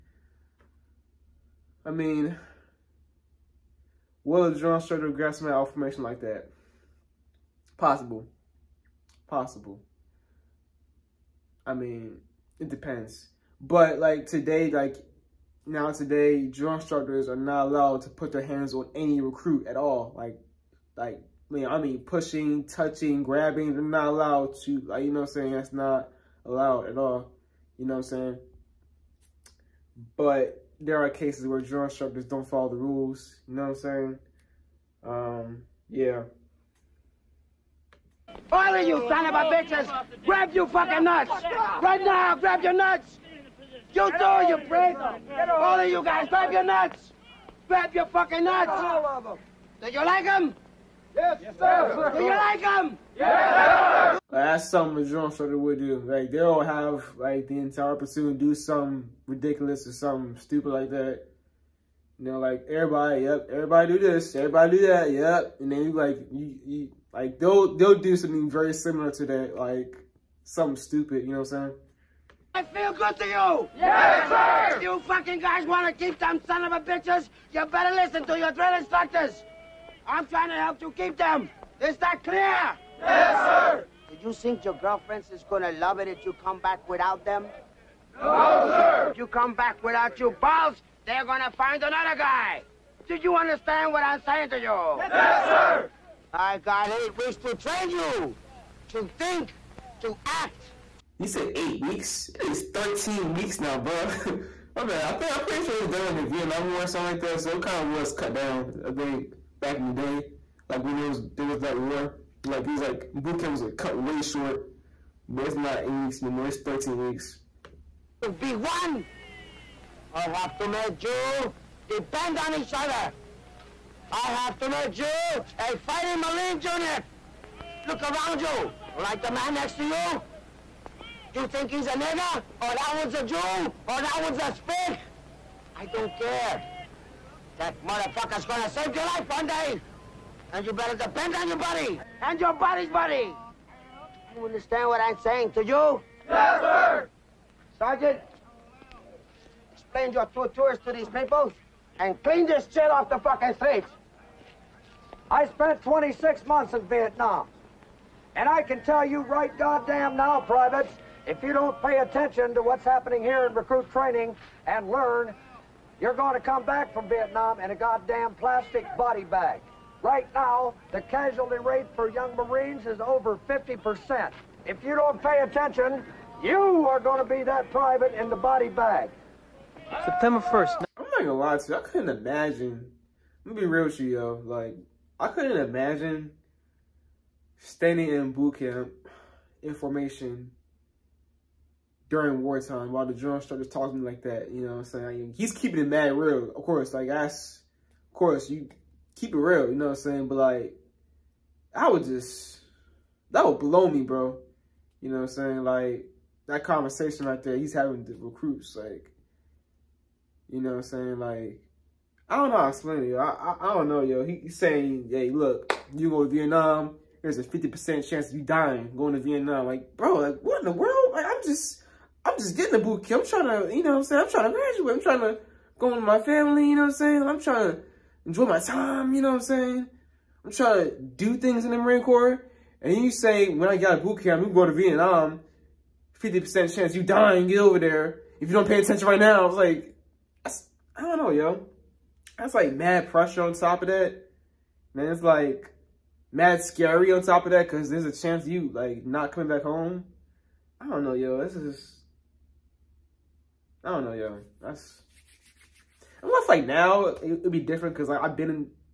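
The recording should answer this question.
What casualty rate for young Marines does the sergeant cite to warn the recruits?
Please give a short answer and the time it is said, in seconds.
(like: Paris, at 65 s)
over 50%, at 173 s.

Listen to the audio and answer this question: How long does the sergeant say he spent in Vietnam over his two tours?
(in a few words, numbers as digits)
26 months.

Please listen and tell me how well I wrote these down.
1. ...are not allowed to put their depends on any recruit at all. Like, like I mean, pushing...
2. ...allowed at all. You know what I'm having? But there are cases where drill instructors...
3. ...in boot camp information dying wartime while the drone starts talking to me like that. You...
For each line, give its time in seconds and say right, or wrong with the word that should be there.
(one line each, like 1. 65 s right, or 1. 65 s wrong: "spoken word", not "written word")
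1. 17 s wrong: "hands", not "depends"
2. 26 s wrong: "saying", not "having"
3. 188 s wrong: "during", not "dying".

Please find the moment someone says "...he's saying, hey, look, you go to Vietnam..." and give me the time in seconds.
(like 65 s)
214 s.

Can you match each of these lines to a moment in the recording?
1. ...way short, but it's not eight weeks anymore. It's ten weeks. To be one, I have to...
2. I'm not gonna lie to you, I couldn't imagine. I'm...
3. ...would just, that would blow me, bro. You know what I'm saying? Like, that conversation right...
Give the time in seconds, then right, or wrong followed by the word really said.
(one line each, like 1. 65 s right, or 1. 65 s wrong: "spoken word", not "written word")
1. 113 s wrong: "thirteen", not "ten"
2. 180 s right
3. 201 s right.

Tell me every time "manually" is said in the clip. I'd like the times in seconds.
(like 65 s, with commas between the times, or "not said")
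not said.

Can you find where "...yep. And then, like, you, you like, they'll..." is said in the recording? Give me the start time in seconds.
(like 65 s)
65 s.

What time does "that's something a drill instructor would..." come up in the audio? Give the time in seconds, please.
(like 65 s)
54 s.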